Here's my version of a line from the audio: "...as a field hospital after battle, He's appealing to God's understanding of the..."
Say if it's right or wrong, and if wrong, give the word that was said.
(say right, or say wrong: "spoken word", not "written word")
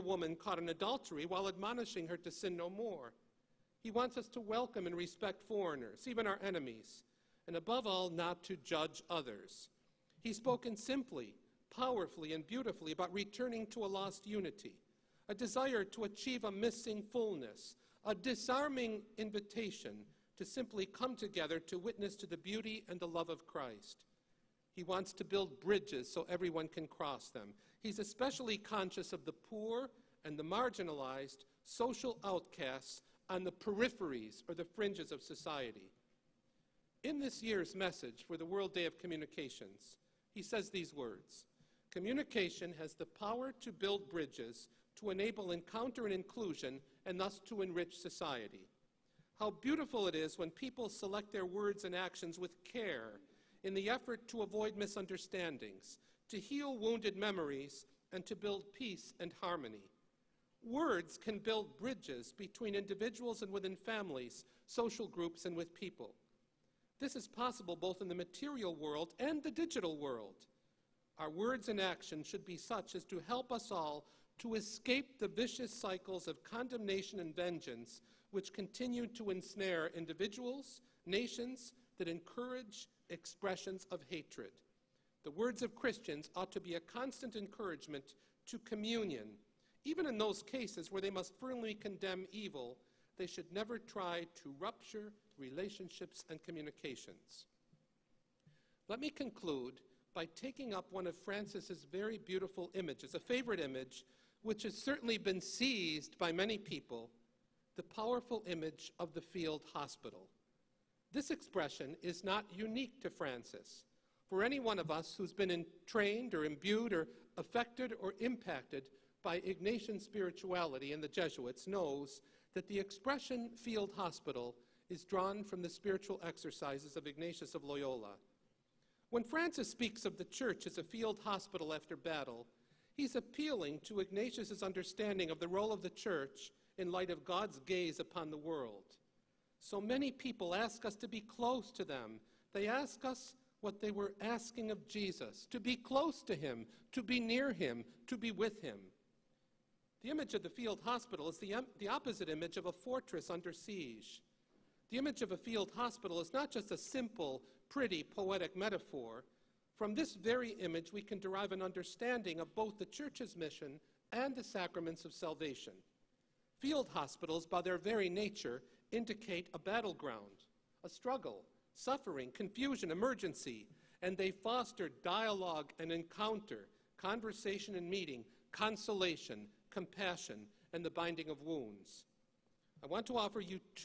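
wrong: "Ignatius", not "God".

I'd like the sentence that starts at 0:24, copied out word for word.
He wants to build bridges so everyone can cross them.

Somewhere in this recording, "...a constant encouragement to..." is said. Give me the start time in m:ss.
1:26.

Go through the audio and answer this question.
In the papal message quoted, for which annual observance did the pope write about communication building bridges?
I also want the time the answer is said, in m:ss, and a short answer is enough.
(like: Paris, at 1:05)
World Day of Communications, at 0:38.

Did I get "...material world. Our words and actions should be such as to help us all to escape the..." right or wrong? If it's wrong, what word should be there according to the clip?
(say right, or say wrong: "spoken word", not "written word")
wrong: "digital", not "material".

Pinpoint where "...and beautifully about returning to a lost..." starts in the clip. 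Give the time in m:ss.
0:12.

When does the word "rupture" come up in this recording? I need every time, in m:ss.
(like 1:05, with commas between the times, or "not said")
1:34.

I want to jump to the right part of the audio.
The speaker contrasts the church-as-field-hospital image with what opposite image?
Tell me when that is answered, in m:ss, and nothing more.
2:32.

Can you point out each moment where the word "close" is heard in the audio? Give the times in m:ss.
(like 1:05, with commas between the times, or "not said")
2:21, 2:25.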